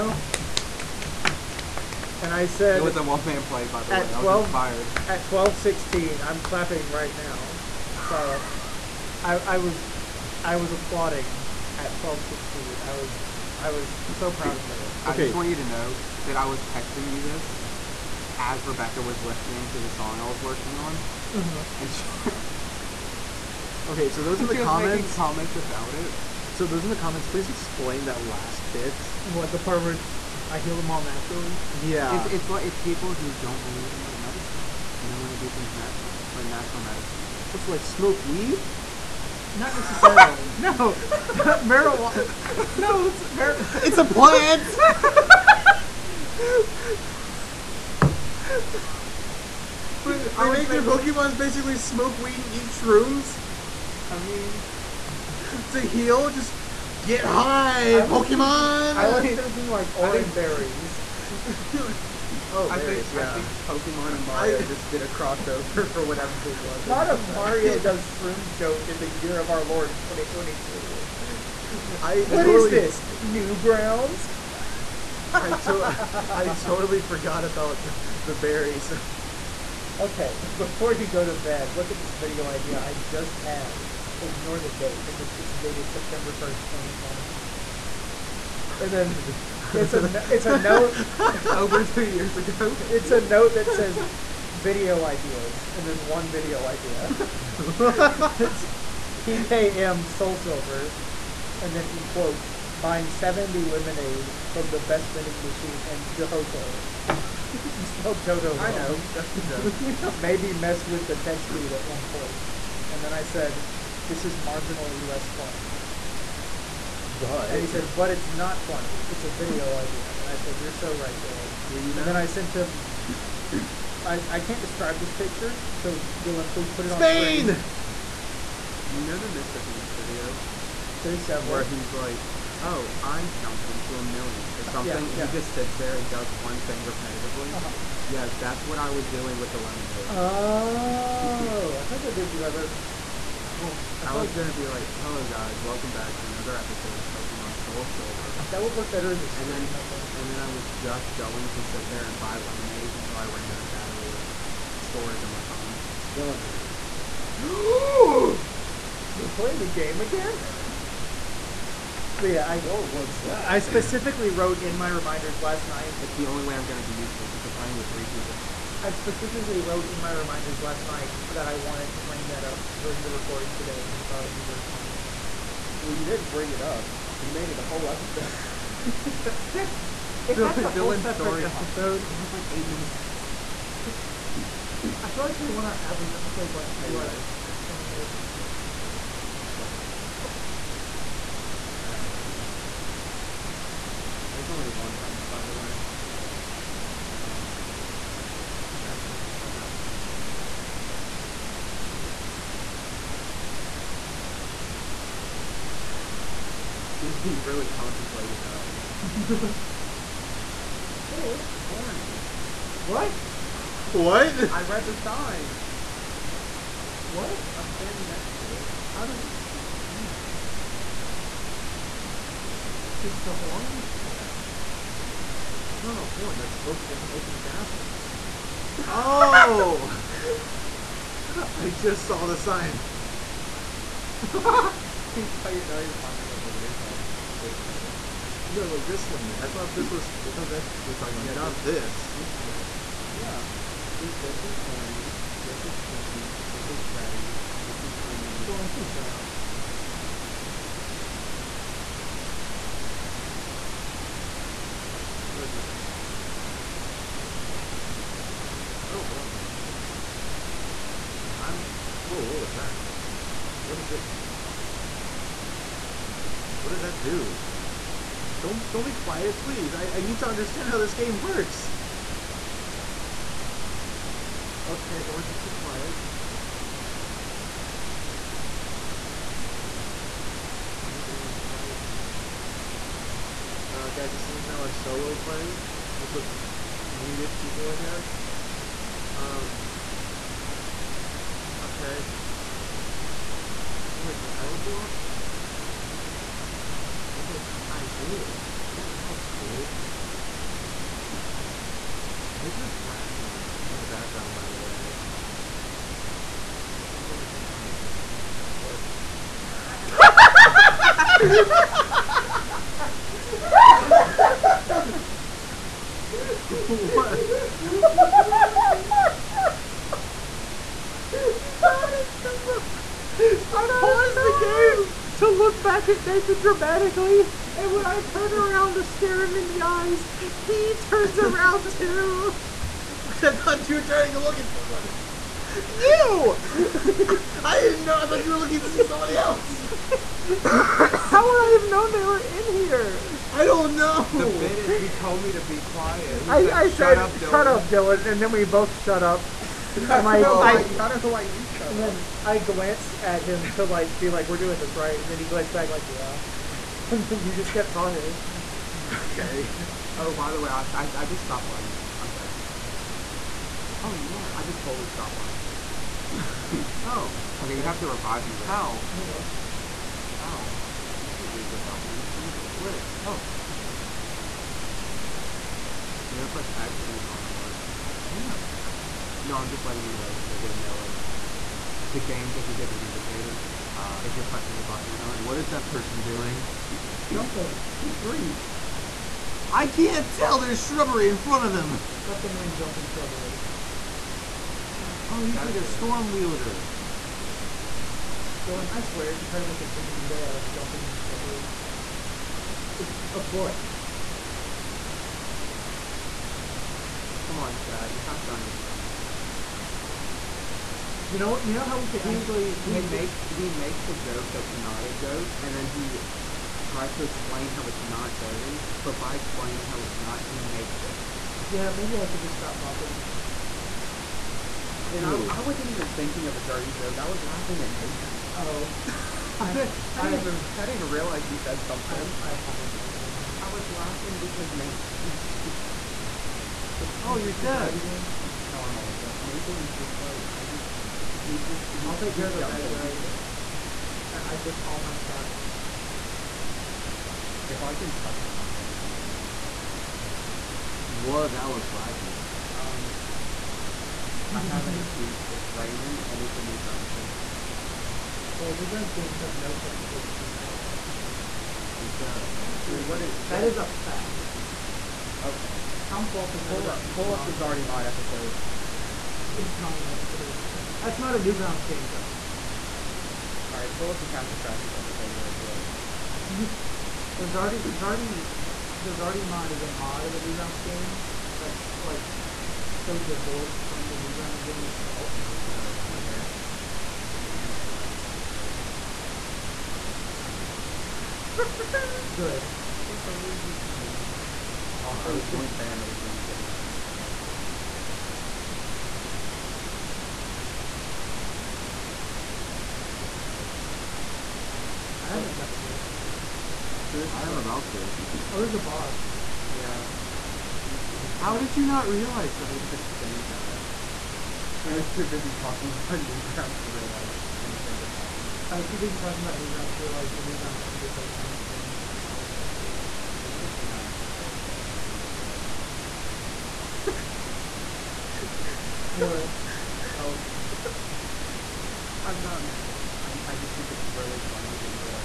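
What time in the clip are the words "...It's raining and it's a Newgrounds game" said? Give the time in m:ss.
7:35.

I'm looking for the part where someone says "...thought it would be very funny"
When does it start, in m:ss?
2:54.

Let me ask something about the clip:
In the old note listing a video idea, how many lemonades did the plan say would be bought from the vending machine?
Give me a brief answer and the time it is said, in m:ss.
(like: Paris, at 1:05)
70, at 1:43.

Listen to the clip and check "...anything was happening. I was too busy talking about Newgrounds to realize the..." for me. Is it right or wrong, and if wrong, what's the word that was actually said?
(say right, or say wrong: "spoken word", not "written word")
right.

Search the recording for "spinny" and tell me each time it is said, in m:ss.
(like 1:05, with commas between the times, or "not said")
8:32.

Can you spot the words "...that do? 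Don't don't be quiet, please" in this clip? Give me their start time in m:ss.
4:26.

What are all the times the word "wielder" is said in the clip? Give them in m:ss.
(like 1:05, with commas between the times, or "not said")
6:36.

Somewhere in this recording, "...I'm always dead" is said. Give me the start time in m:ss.
7:18.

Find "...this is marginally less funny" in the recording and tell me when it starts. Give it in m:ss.
1:54.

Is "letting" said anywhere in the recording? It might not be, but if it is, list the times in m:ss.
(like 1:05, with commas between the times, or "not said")
6:19.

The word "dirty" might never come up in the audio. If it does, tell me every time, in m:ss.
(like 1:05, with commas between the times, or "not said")
6:58, 7:06.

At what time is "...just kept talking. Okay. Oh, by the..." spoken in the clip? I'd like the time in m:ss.
5:57.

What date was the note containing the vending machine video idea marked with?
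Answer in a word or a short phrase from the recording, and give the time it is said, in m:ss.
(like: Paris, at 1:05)
September 1st, 2020, at 1:25.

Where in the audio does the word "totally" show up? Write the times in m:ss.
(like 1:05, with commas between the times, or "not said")
1:12, 1:16.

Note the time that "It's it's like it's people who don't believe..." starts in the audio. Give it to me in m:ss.
0:32.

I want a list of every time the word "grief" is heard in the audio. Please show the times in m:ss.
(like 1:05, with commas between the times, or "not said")
6:27.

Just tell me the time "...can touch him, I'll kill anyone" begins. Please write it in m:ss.
7:27.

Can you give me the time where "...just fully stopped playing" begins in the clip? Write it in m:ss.
6:04.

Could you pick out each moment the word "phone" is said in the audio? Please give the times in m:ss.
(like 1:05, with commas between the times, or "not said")
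2:35.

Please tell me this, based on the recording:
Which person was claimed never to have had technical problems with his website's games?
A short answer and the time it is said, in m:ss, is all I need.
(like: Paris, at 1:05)
Tom Fulp, at 7:45.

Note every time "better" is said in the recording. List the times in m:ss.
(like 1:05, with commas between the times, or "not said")
2:22, 2:28.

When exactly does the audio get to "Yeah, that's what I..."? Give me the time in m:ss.
2:18.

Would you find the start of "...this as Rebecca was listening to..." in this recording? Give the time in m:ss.
0:17.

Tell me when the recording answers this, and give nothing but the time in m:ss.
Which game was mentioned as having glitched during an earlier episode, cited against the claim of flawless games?
7:54.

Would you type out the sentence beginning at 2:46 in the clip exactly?
It's the only way I'm gonna be useful because we're playing with three people.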